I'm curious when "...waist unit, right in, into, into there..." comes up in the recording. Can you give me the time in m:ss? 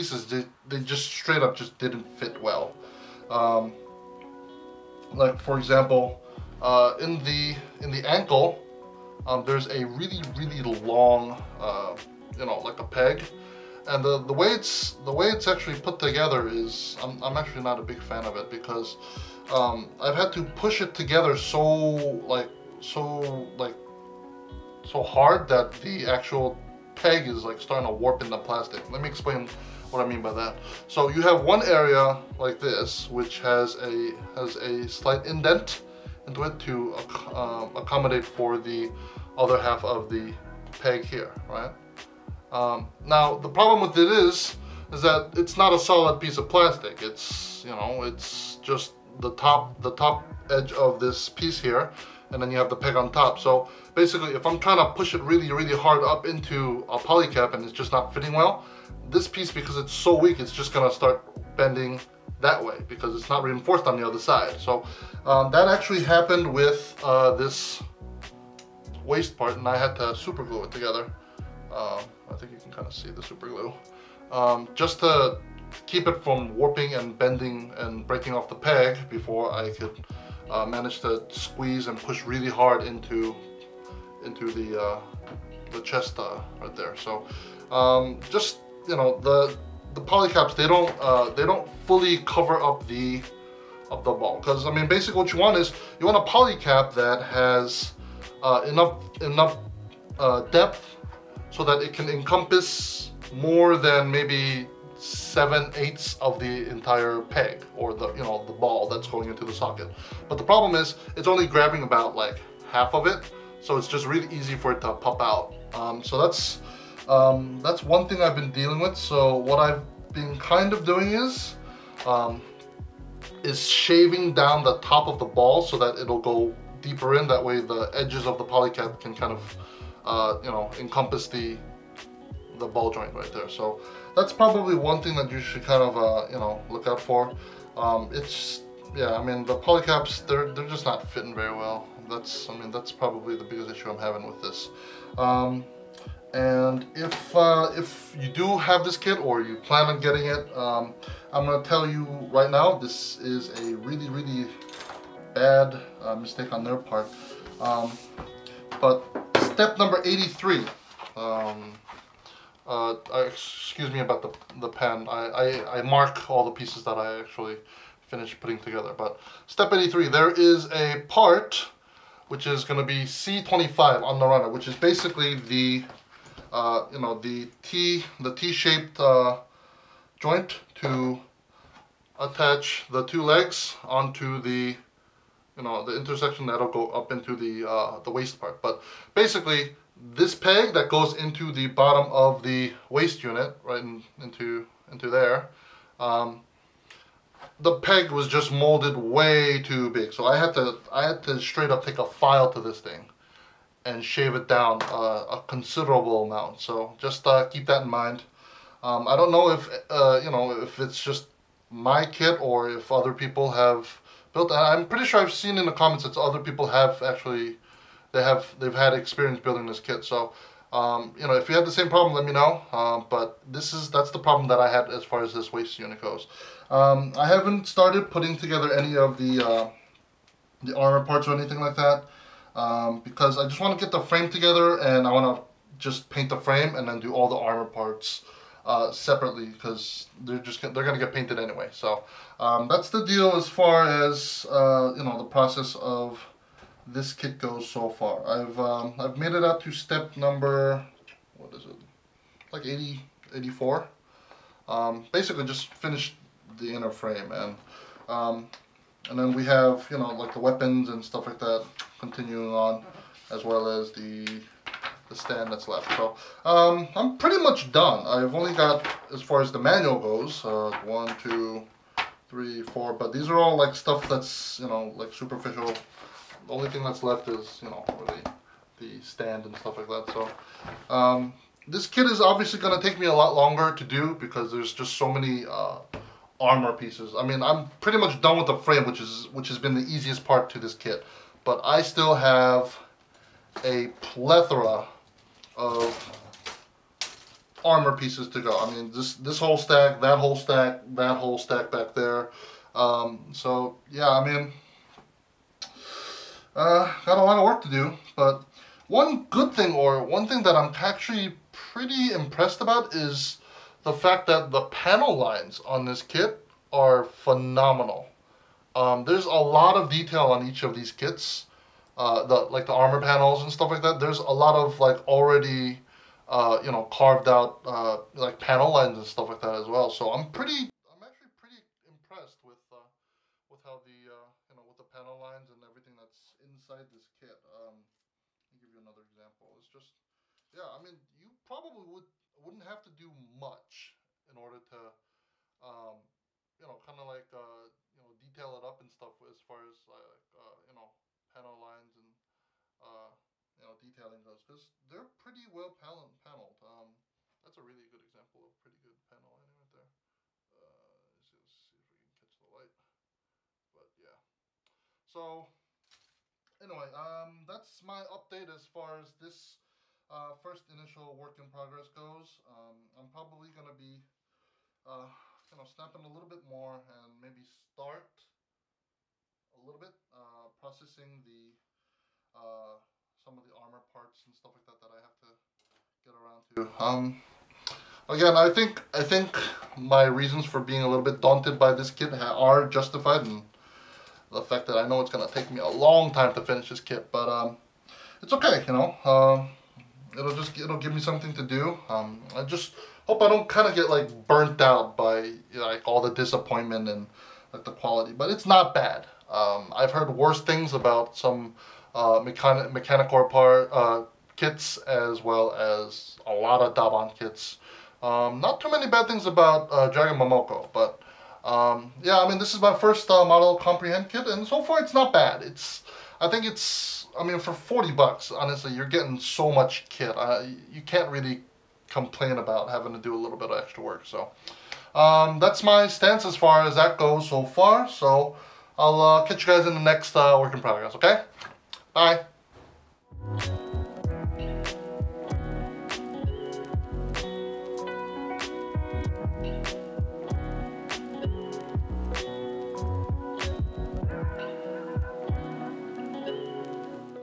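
3:12.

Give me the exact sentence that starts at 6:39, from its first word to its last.
Um, it'll just it'll give me something to do.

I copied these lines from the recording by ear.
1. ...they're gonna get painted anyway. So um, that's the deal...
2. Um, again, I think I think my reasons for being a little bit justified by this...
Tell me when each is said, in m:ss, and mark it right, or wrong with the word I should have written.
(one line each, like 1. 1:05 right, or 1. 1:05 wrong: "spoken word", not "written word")
1. 4:00 right
2. 6:26 wrong: "daunted", not "justified".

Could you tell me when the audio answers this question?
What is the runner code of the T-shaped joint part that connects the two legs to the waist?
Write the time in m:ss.
2:53.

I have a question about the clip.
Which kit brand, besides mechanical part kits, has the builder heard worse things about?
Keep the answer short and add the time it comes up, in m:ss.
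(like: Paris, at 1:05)
Daban, at 6:56.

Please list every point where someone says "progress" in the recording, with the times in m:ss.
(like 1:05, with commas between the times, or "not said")
6:11, 7:20.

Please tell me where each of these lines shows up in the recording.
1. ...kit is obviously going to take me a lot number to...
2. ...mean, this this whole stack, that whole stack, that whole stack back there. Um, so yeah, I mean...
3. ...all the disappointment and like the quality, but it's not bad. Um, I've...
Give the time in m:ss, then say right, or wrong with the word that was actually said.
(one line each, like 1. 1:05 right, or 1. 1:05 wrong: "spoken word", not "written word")
1. 4:41 wrong: "longer", not "number"
2. 4:58 right
3. 6:45 right.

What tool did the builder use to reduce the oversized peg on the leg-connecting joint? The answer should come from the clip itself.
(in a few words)
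A file.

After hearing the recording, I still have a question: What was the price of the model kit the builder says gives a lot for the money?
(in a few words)
$40.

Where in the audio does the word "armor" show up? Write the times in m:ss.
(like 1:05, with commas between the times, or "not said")
3:50, 3:57, 4:46, 4:57, 5:22, 6:23.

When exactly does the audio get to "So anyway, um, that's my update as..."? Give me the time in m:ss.
6:05.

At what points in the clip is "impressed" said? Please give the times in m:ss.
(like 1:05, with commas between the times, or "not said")
5:12, 5:31.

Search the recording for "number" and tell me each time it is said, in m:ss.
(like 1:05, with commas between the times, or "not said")
2:39, 4:10.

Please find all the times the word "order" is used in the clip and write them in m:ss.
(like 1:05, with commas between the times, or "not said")
5:44.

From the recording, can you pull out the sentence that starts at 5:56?
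Um, that's a really good example of pretty good panel lining right there.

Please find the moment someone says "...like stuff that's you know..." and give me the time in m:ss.
4:33.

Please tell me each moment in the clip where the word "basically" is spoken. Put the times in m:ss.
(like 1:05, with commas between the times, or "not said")
0:53, 1:34, 2:54, 3:09, 4:15.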